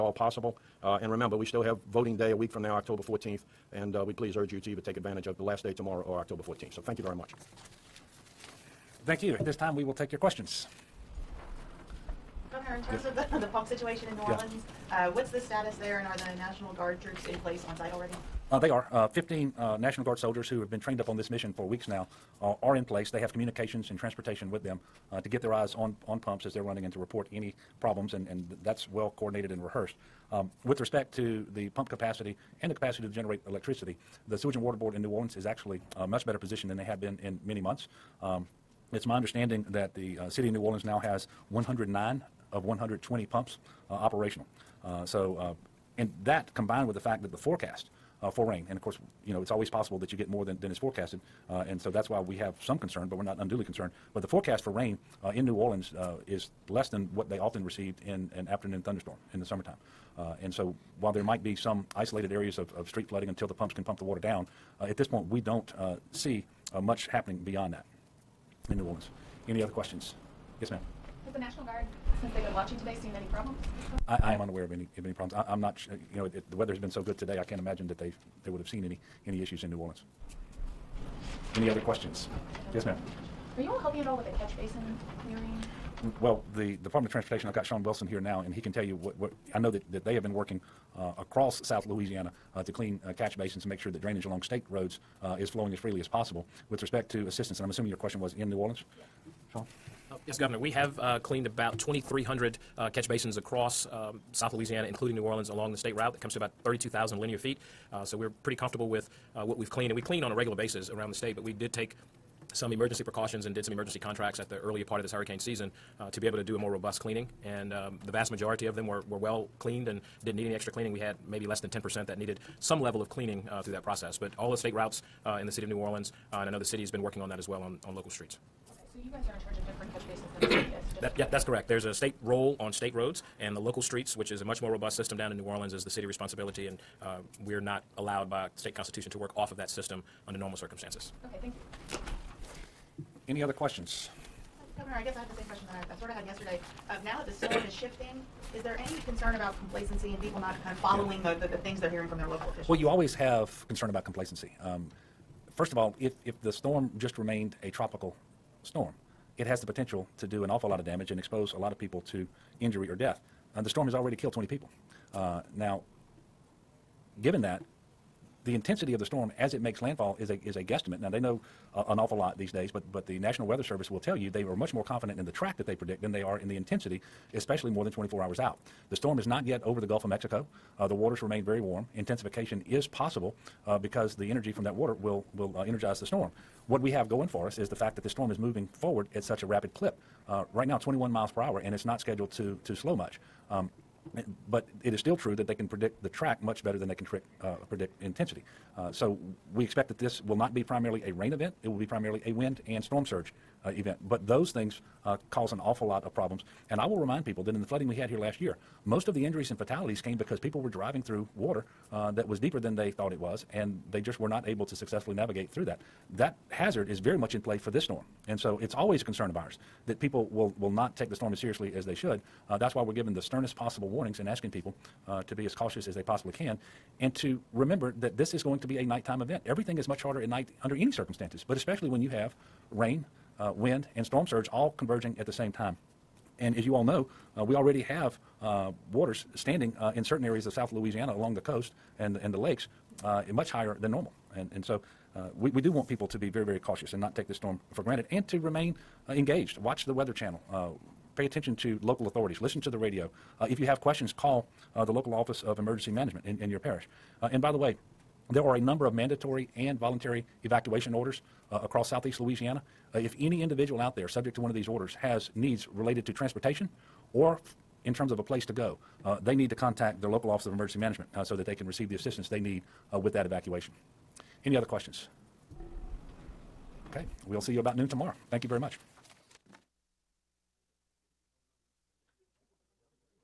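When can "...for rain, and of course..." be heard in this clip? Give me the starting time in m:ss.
0:48.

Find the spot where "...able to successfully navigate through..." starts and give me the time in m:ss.
3:34.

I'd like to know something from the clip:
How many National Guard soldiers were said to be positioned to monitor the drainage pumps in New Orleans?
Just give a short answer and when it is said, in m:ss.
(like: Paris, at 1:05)
15, at 0:19.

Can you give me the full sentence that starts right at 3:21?
It will be primarily a wind and storm surge uh, event.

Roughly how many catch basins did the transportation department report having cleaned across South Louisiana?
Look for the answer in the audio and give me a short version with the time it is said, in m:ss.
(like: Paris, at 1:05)
2,300, at 1:41.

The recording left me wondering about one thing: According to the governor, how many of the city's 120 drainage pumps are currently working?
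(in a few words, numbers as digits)
109.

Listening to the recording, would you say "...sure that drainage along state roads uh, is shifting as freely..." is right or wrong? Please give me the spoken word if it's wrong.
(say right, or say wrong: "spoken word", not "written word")
wrong: "flowing", not "shifting".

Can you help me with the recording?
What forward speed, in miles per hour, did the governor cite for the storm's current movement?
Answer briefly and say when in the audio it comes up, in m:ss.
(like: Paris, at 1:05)
21, at 3:10.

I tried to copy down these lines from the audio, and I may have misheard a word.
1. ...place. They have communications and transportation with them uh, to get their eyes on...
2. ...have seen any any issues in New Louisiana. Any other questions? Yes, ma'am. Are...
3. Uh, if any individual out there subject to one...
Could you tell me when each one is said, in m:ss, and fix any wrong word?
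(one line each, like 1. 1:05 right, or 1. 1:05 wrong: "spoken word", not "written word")
1. 0:22 right
2. 1:18 wrong: "Orleans", not "Louisiana"
3. 4:22 right.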